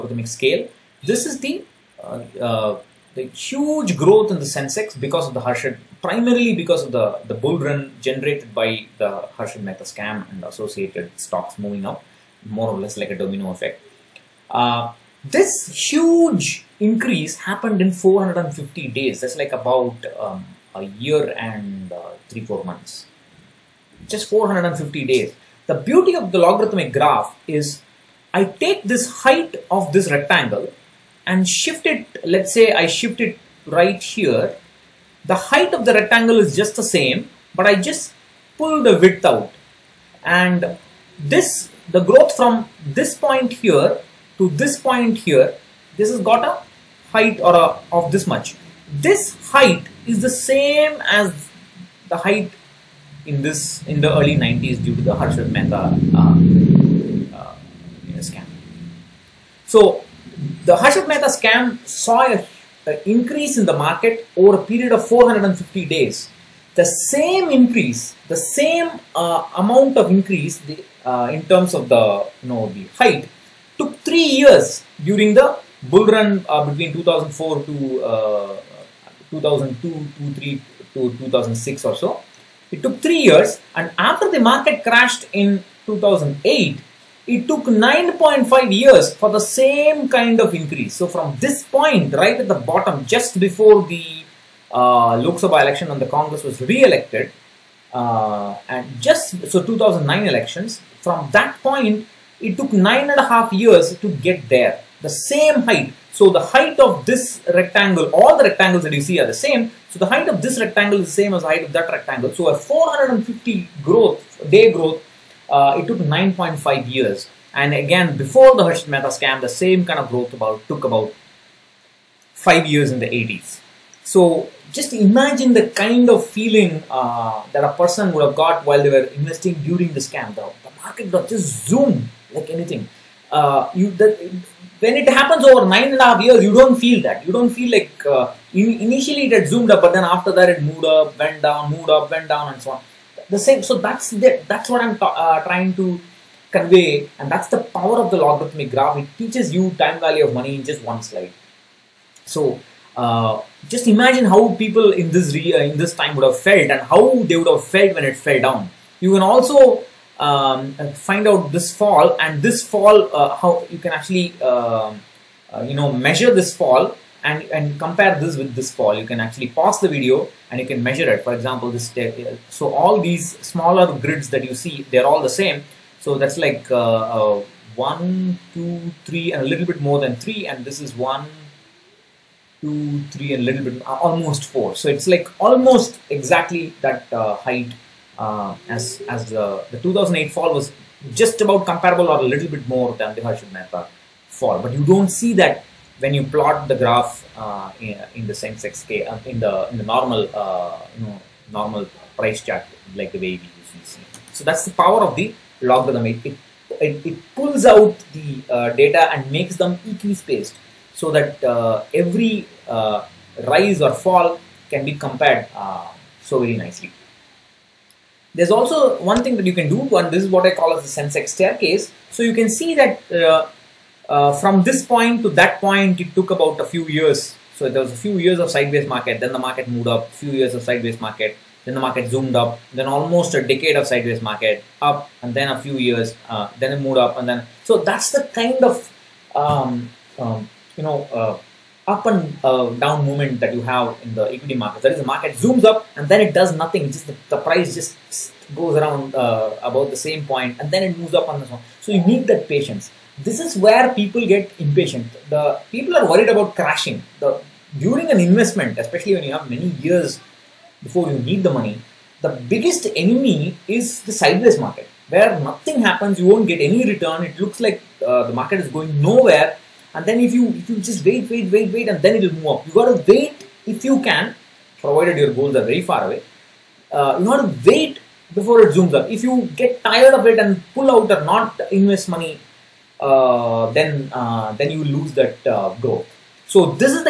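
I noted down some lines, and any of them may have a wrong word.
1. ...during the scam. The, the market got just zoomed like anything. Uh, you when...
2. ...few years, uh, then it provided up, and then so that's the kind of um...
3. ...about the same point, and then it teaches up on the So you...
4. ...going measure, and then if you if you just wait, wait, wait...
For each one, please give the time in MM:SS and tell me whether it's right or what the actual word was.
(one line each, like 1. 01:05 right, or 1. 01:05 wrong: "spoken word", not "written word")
1. 02:09 right
2. 03:55 wrong: "moved", not "provided"
3. 04:09 wrong: "moves", not "teaches"
4. 04:28 wrong: "nowhere", not "measure".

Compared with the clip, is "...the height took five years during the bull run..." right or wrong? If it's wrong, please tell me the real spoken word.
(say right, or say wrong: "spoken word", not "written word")
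wrong: "three", not "five".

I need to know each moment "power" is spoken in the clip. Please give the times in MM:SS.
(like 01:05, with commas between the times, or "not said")
02:27, 03:24.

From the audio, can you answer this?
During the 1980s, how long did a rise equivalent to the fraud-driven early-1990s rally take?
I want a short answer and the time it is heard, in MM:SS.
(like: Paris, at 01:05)
5 years, at 02:02.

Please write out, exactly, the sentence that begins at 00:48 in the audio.
This height is the same as the height in this in the early 90s due to the Harshad Mehta uh, uh, scan.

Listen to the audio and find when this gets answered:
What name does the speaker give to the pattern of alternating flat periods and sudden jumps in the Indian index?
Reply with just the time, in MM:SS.
03:40.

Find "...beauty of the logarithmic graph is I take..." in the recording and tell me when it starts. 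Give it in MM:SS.
00:25.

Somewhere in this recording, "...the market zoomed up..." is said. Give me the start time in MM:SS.
03:51.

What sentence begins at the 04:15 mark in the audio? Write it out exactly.
The people are worried about crashing.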